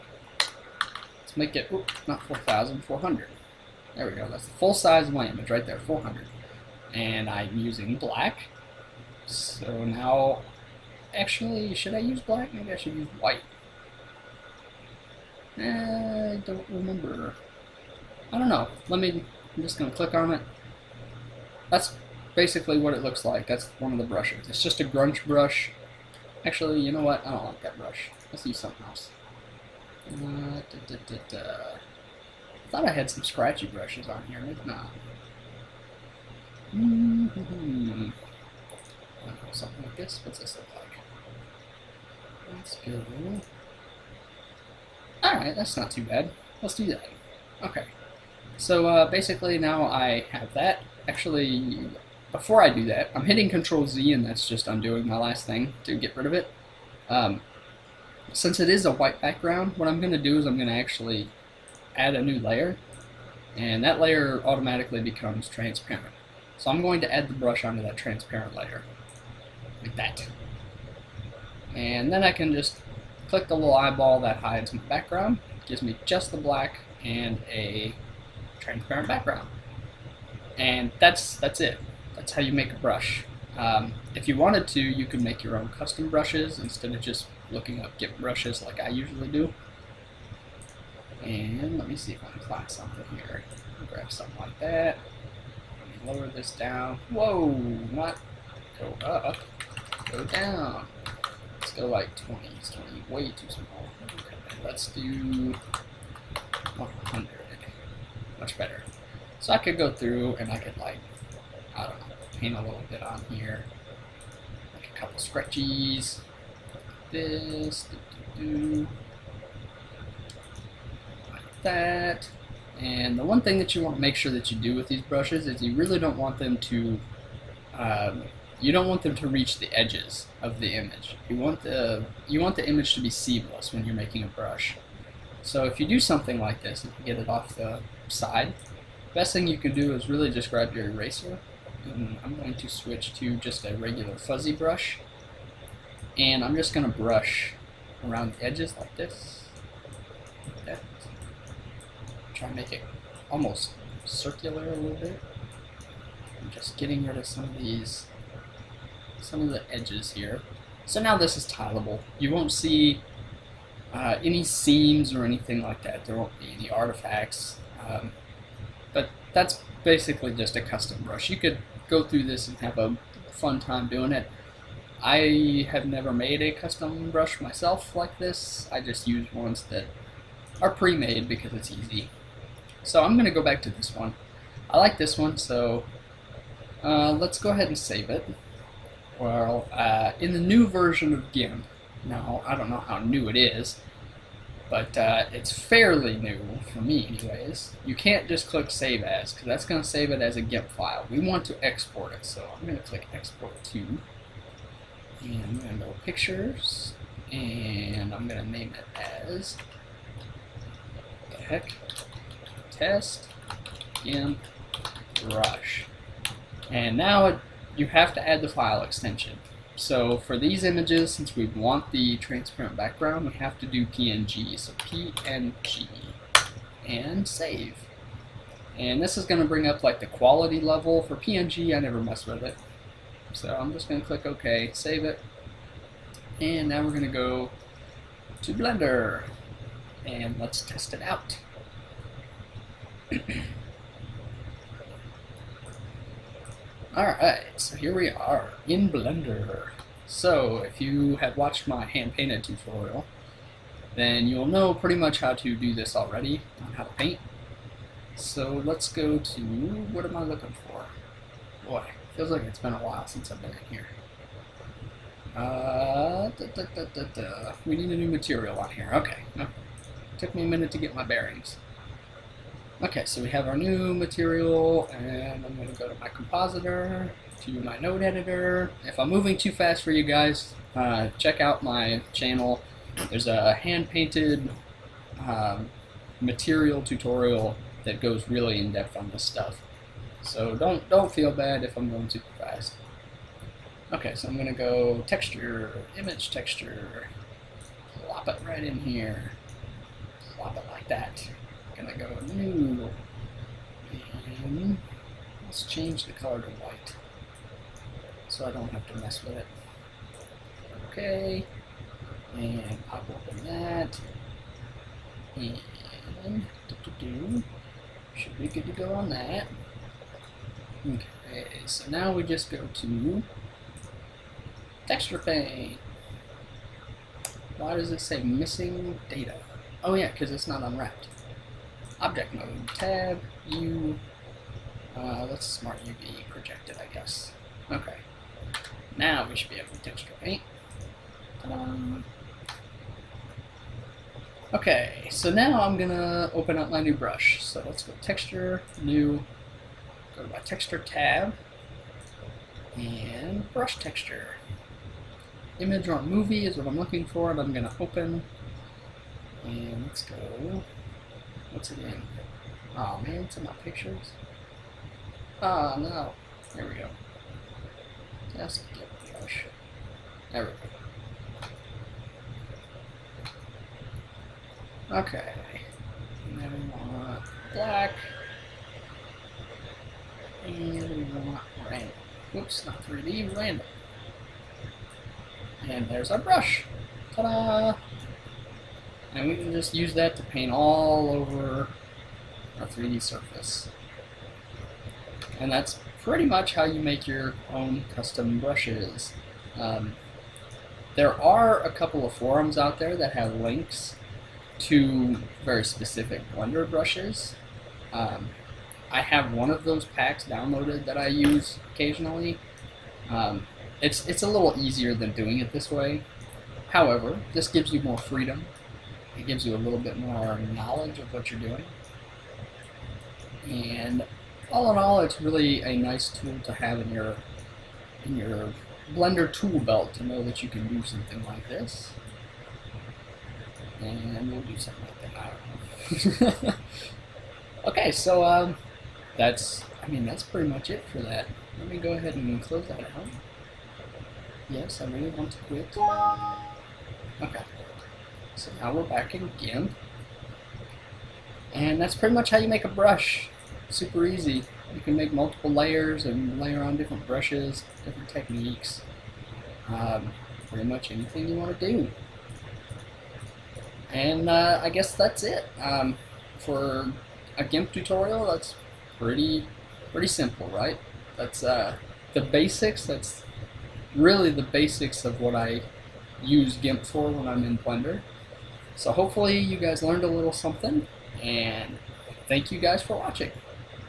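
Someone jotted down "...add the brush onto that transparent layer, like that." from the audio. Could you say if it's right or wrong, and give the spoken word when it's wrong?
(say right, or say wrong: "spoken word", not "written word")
right.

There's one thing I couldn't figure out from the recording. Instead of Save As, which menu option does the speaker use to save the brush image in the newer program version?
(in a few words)
Export To.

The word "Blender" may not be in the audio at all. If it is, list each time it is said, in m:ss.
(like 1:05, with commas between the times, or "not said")
3:58, 4:08, 6:46, 7:08, 7:57.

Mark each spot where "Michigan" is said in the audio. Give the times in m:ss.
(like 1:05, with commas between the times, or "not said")
not said.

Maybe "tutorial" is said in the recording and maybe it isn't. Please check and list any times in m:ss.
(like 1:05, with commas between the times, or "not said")
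4:12, 4:46, 7:47.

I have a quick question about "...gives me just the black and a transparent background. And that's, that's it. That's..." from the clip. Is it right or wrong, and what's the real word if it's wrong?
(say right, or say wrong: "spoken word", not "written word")
right.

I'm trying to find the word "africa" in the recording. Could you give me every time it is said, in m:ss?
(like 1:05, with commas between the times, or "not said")
not said.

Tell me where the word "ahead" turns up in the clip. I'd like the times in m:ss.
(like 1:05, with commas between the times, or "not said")
3:07, 7:21.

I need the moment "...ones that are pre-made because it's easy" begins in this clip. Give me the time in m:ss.
2:59.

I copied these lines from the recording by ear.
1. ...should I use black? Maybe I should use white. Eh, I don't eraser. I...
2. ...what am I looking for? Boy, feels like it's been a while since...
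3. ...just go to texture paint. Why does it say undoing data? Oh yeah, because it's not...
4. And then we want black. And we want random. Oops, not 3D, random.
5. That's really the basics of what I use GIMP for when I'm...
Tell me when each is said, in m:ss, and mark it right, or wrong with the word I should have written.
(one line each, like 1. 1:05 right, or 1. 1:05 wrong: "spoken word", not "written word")
1. 0:11 wrong: "remember", not "eraser"
2. 4:19 right
3. 5:22 wrong: "missing", not "undoing"
4. 6:16 right
5. 7:52 right.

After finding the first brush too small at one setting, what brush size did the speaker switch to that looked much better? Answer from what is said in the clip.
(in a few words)
100.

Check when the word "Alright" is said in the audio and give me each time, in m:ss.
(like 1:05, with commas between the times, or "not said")
0:45, 4:06.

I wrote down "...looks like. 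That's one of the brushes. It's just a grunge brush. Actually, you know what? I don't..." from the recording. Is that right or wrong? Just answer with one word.
right.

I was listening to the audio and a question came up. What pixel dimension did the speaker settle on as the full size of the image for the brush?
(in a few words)
400.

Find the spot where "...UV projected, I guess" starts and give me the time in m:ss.
5:35.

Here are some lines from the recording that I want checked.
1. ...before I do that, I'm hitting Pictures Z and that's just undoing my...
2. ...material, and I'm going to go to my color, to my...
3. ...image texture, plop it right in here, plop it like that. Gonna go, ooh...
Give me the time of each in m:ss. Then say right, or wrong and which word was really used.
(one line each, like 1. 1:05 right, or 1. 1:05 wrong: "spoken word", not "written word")
1. 0:52 wrong: "Control", not "Pictures"
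2. 4:33 wrong: "compositor", not "color"
3. 4:55 right.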